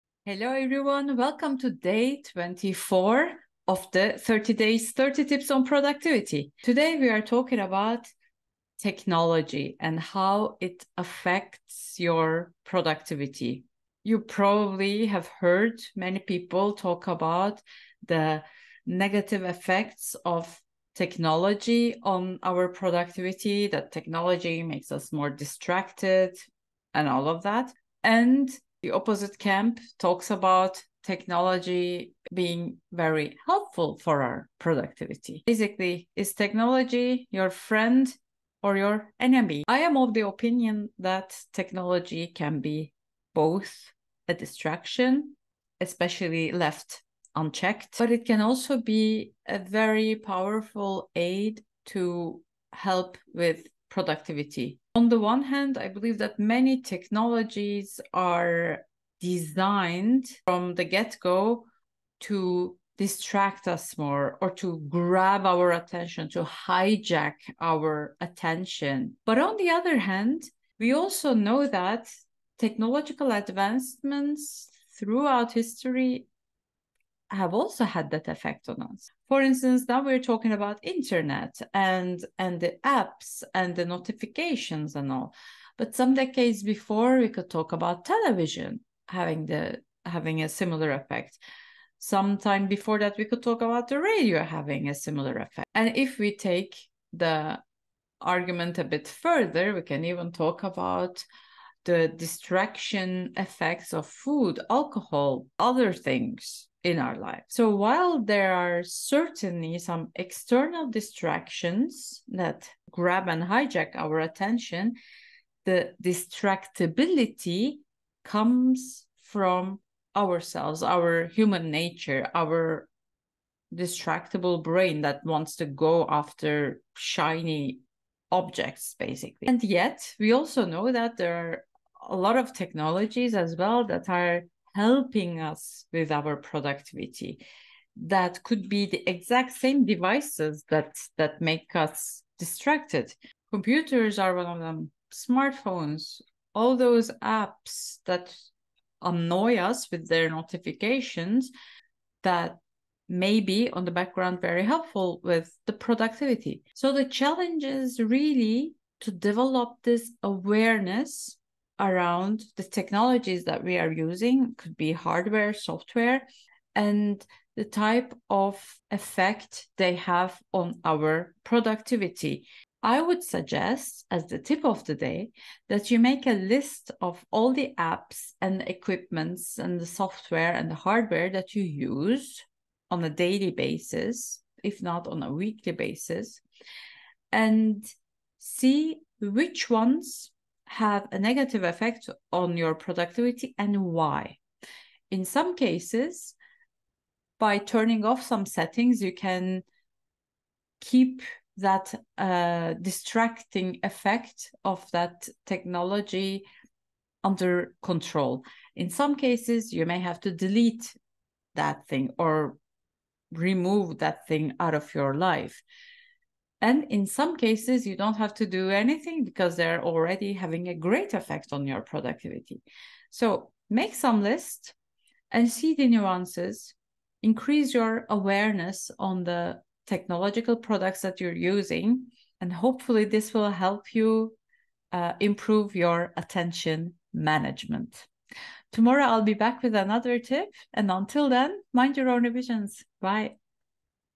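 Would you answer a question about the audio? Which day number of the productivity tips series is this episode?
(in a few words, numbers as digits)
24.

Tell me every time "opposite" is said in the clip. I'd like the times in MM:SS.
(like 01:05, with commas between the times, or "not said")
00:28.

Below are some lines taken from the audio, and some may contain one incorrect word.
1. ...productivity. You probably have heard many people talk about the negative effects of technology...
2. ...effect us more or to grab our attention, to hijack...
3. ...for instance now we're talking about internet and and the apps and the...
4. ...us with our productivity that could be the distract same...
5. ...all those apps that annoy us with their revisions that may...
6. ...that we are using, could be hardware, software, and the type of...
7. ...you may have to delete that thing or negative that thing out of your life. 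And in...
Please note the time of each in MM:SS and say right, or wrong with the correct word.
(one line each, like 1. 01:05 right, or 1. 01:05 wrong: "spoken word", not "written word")
1. 00:12 right
2. 01:02 wrong: "distract", not "effect"
3. 01:19 right
4. 02:15 wrong: "exact", not "distract"
5. 02:26 wrong: "notifications", not "revisions"
6. 02:43 right
7. 03:29 wrong: "remove", not "negative".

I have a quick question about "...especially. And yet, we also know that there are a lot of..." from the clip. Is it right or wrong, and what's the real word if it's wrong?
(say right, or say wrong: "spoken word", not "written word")
wrong: "basically", not "especially".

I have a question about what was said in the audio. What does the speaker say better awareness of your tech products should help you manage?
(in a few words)
attention management.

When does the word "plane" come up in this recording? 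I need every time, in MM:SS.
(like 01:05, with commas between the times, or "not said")
not said.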